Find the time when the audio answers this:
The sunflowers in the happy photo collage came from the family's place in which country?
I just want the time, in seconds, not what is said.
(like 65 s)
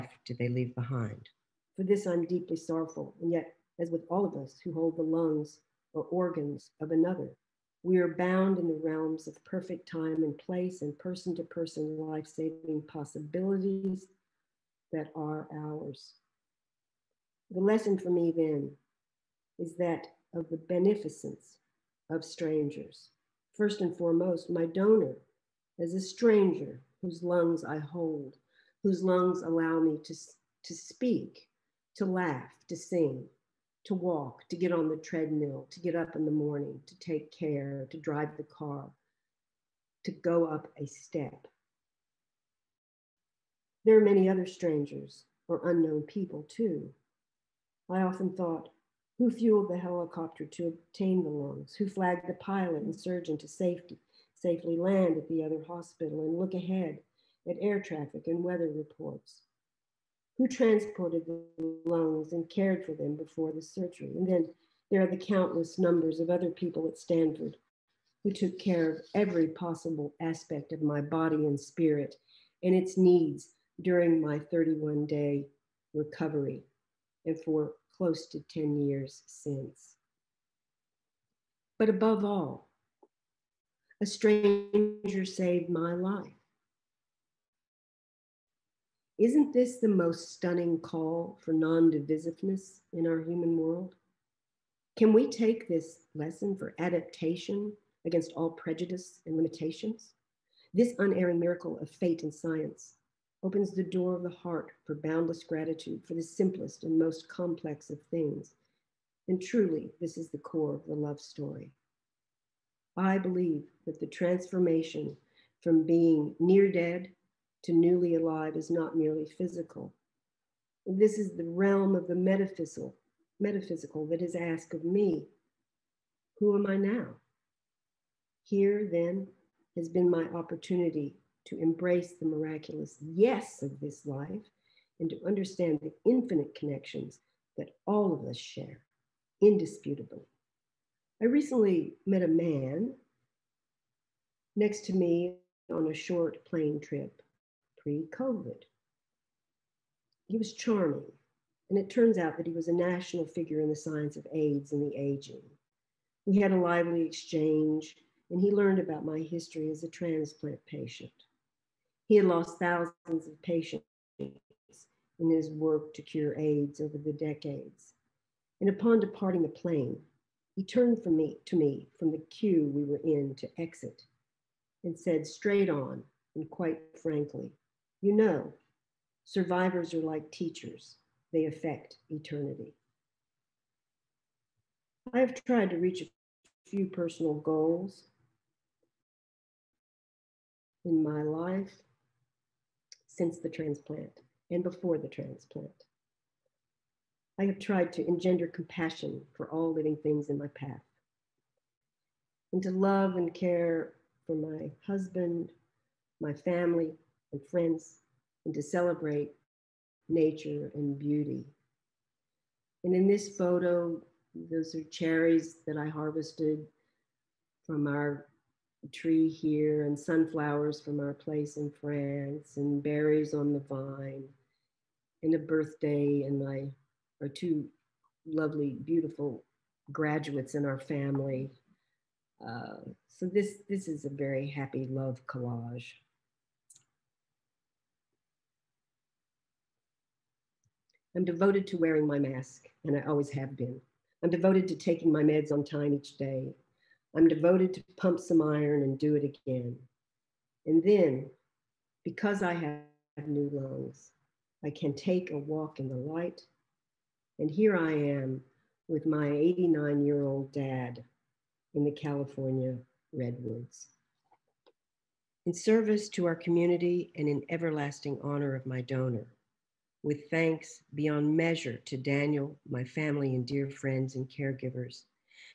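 221 s.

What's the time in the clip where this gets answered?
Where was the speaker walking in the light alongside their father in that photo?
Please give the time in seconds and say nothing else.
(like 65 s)
261 s.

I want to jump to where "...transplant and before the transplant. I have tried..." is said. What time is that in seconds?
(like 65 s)
193 s.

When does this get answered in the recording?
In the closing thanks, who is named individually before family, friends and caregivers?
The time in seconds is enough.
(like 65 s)
271 s.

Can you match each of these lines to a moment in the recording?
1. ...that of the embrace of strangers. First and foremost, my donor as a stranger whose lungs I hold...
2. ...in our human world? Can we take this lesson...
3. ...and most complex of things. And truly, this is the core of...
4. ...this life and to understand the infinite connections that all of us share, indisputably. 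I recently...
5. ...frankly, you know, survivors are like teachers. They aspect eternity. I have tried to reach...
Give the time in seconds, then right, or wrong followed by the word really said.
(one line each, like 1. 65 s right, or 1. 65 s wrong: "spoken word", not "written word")
1. 19 s wrong: "beneficence", not "embrace"
2. 92 s right
3. 106 s right
4. 133 s right
5. 177 s wrong: "affect", not "aspect".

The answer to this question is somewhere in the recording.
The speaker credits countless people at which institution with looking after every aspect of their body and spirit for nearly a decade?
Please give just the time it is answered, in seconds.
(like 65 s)
66 s.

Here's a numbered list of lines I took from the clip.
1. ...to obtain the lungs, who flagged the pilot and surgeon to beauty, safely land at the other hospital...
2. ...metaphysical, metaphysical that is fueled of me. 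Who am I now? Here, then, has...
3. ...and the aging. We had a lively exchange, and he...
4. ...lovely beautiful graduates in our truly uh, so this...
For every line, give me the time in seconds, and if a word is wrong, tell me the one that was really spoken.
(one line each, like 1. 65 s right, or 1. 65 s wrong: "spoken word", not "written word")
1. 50 s wrong: "safety", not "beauty"
2. 122 s wrong: "asked", not "fueled"
3. 154 s right
4. 228 s wrong: "family", not "truly".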